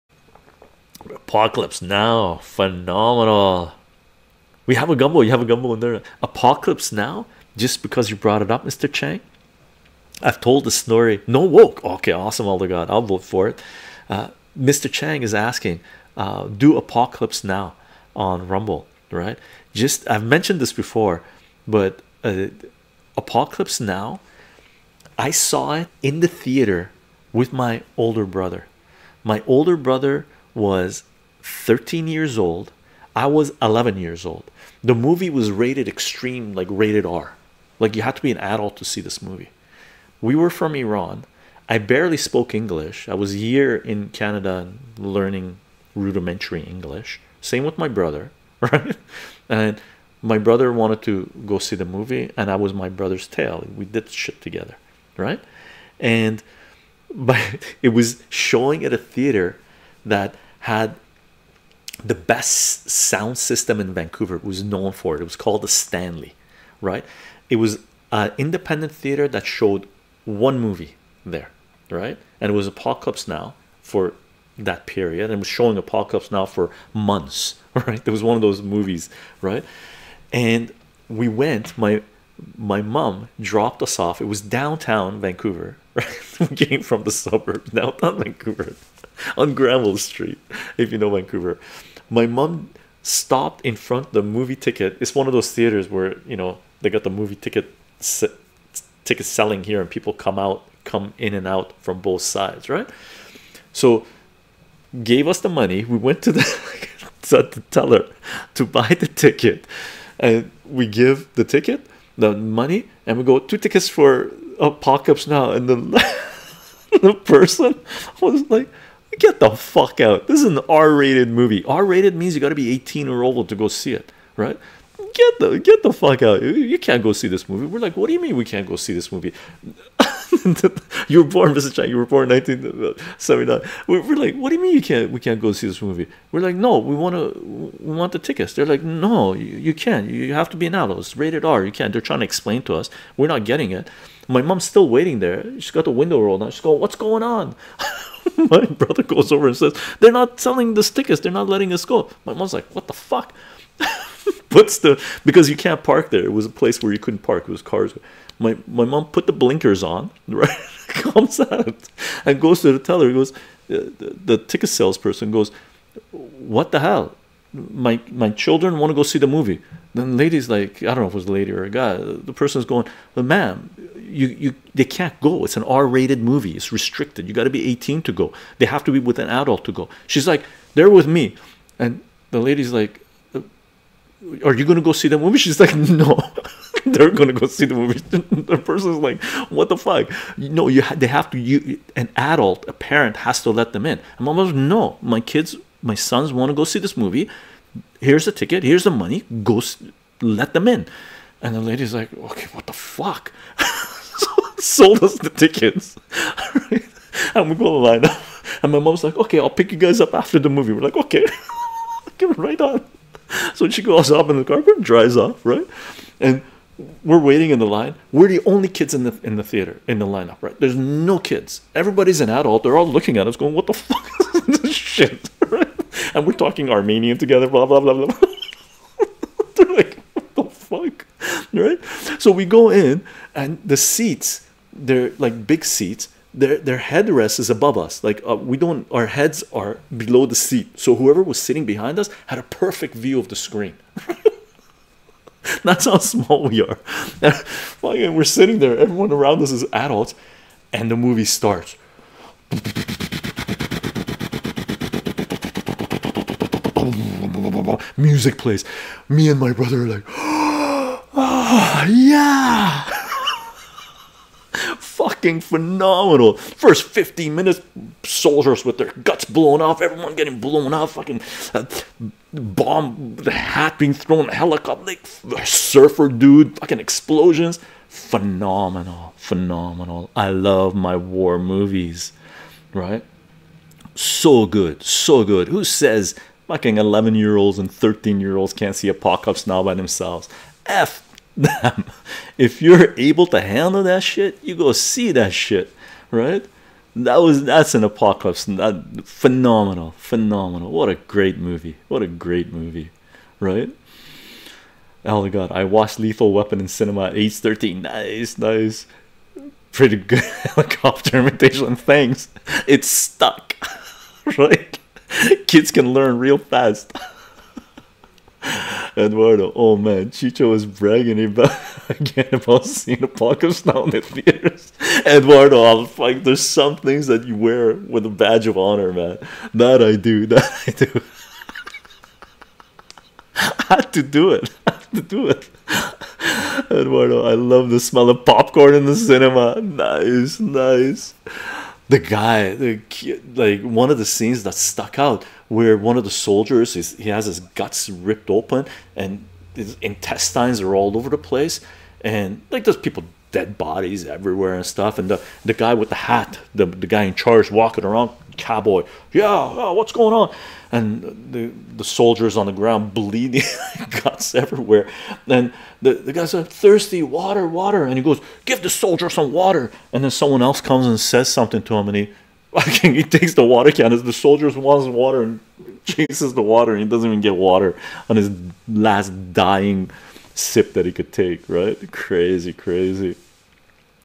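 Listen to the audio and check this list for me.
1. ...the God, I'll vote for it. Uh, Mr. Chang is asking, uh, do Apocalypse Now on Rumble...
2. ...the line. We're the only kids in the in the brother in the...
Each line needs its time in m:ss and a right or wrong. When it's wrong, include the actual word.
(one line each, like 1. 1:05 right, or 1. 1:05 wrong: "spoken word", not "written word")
1. 0:12 right
2. 3:37 wrong: "theater", not "brother".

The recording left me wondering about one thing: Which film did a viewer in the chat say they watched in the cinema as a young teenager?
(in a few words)
Lethal Weapon.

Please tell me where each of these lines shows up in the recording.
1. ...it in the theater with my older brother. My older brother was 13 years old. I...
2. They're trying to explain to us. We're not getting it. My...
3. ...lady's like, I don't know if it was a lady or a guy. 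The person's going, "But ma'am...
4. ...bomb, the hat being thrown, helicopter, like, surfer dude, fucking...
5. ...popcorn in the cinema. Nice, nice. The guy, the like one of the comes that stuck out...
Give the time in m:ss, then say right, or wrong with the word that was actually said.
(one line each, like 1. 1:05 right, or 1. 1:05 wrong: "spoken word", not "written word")
1. 0:25 right
2. 2:21 right
3. 2:50 right
4. 4:32 right
5. 5:38 wrong: "scenes", not "comes".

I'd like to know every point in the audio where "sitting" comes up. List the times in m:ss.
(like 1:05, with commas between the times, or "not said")
4:01, 4:08.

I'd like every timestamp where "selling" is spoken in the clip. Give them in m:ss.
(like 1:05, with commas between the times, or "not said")
1:39, 2:30.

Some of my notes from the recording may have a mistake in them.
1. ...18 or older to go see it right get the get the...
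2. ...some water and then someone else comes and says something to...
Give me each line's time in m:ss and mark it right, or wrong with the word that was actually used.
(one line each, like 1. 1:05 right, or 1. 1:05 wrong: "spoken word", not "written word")
1. 2:02 right
2. 6:09 right.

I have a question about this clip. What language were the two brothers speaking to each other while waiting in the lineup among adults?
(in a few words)
Armenian.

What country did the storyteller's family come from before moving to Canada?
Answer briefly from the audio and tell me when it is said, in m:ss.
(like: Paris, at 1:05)
Iran, at 0:40.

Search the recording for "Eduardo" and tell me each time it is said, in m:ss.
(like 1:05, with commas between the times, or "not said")
5:18, 5:25, 5:36.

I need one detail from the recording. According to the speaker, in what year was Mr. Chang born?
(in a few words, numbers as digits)
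1979.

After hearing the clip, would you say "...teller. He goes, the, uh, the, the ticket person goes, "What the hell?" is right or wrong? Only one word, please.
wrong.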